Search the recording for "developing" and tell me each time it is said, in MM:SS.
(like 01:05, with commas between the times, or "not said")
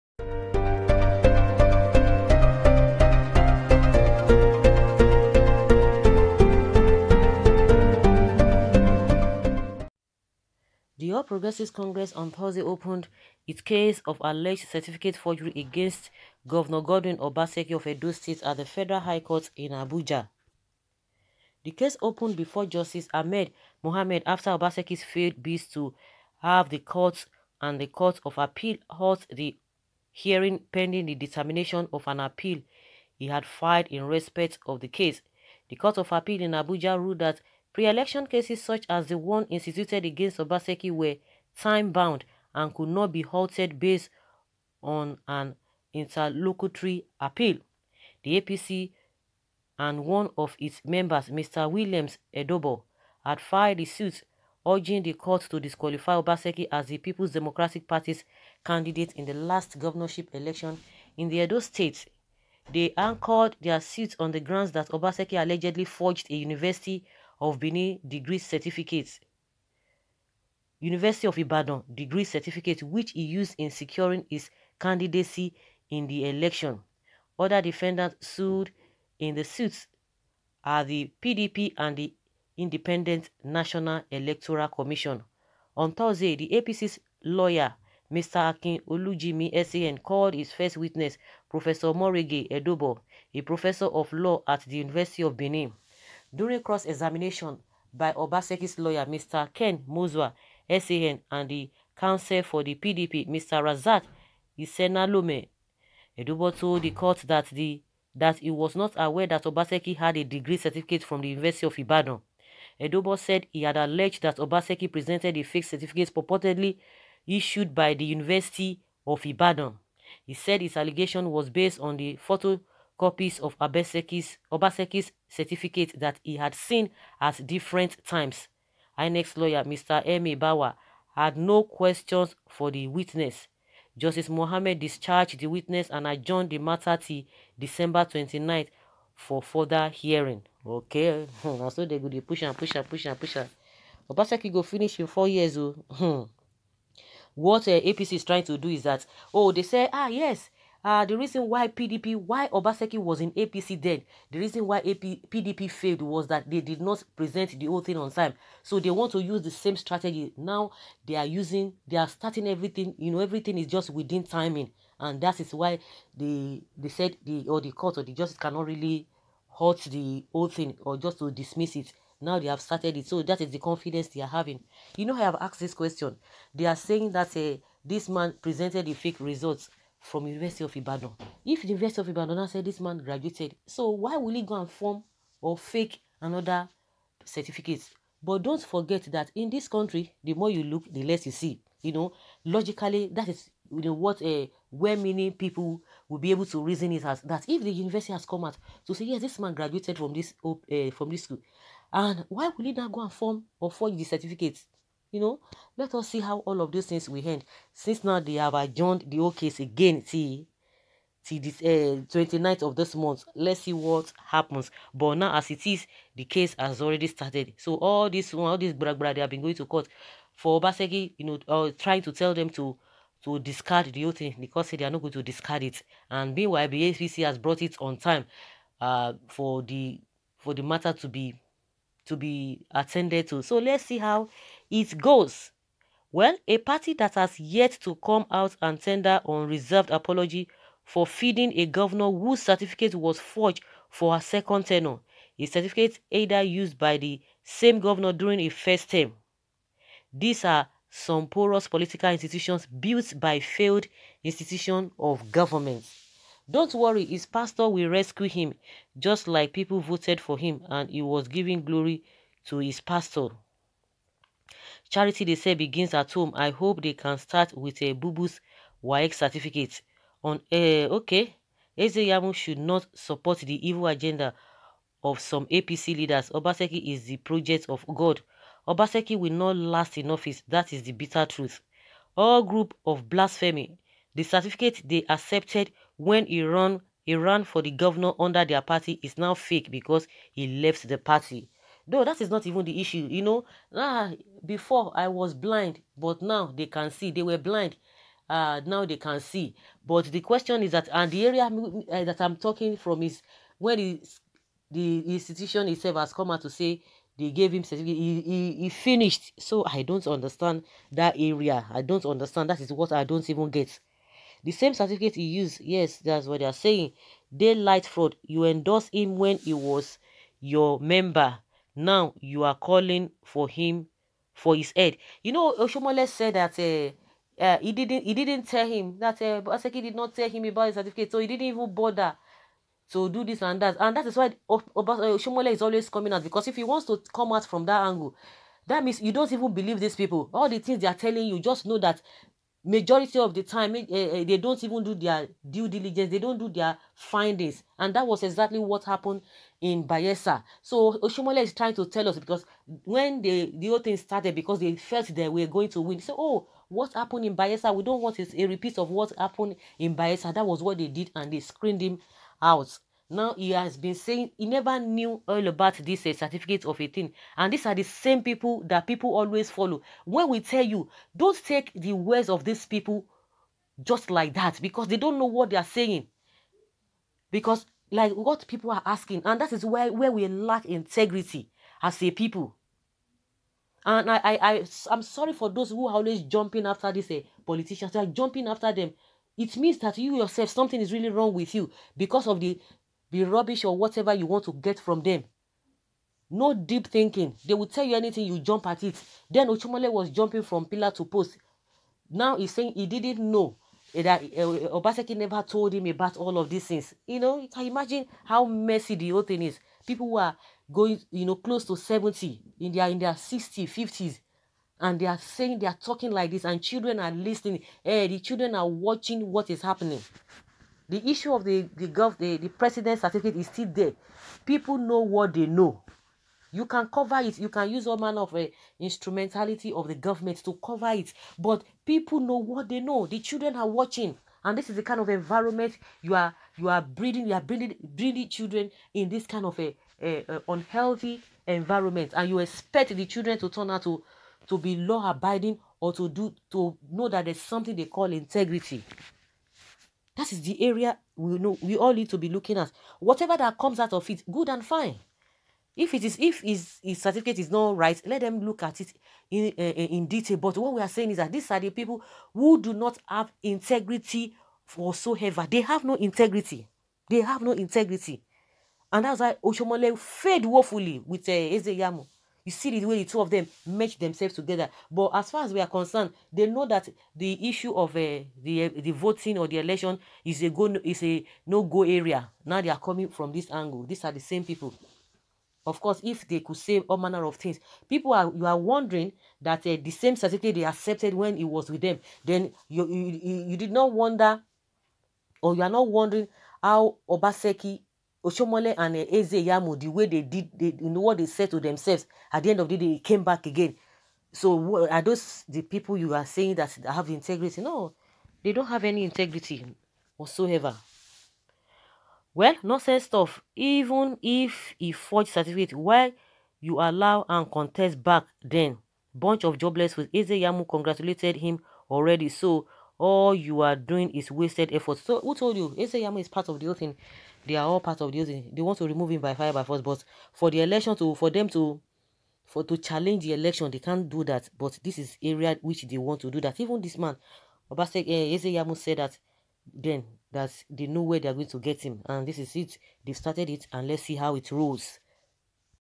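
not said.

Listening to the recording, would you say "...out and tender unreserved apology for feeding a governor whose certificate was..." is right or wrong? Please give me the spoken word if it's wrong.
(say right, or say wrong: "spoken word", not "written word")
right.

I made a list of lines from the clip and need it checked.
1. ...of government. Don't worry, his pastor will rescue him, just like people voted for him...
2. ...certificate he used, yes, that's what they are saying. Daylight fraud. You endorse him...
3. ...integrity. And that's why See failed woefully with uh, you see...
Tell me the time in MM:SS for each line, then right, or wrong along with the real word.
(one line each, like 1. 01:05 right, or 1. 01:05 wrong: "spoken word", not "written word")
1. 04:14 right
2. 05:14 right
3. 07:47 wrong: "Oshiomhole", not "See".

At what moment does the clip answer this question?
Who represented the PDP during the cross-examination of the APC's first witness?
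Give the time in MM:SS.
01:43.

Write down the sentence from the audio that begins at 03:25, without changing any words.
You know, let us see how all of those things will end.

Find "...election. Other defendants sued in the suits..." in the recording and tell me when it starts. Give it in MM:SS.
01:16.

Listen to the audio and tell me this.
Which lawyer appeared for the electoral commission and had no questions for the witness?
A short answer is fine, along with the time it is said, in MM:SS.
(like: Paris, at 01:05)
Emi Bawa, at 02:09.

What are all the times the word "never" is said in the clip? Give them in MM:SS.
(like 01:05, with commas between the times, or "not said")
06:04, 06:45.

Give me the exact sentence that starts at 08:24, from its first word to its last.
So are those the people you are saying that have integrity?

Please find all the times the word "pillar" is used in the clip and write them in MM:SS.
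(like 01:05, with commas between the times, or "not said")
06:40.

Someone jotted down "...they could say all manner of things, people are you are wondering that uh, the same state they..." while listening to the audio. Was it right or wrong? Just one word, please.
wrong.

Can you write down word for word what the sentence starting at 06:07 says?
And these are the same people that people always follow.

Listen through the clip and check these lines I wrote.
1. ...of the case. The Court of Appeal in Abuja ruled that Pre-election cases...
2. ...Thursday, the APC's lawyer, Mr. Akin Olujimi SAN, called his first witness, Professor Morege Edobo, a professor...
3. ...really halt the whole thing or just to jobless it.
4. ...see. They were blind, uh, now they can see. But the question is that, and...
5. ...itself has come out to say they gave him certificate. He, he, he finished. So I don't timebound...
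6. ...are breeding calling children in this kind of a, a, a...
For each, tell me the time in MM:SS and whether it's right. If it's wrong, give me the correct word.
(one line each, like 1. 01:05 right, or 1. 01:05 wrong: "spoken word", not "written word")
1. 00:34 right
2. 01:25 right
3. 02:48 wrong: "dismiss", not "jobless"
4. 04:56 right
5. 05:05 wrong: "understand", not "timebound"
6. 07:17 wrong: "breeding", not "calling".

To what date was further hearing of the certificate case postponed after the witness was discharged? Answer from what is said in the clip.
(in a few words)
December 29.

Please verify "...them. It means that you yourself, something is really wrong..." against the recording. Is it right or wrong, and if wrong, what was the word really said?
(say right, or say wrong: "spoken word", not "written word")
right.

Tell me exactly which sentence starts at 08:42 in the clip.
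So all you are doing is wasted effort.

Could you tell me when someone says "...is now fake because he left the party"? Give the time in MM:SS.
04:49.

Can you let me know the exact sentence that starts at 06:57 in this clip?
Hey, eh, the children are watching what is happening.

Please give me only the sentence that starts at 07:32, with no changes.
Whatever that comes out of it, good and fine.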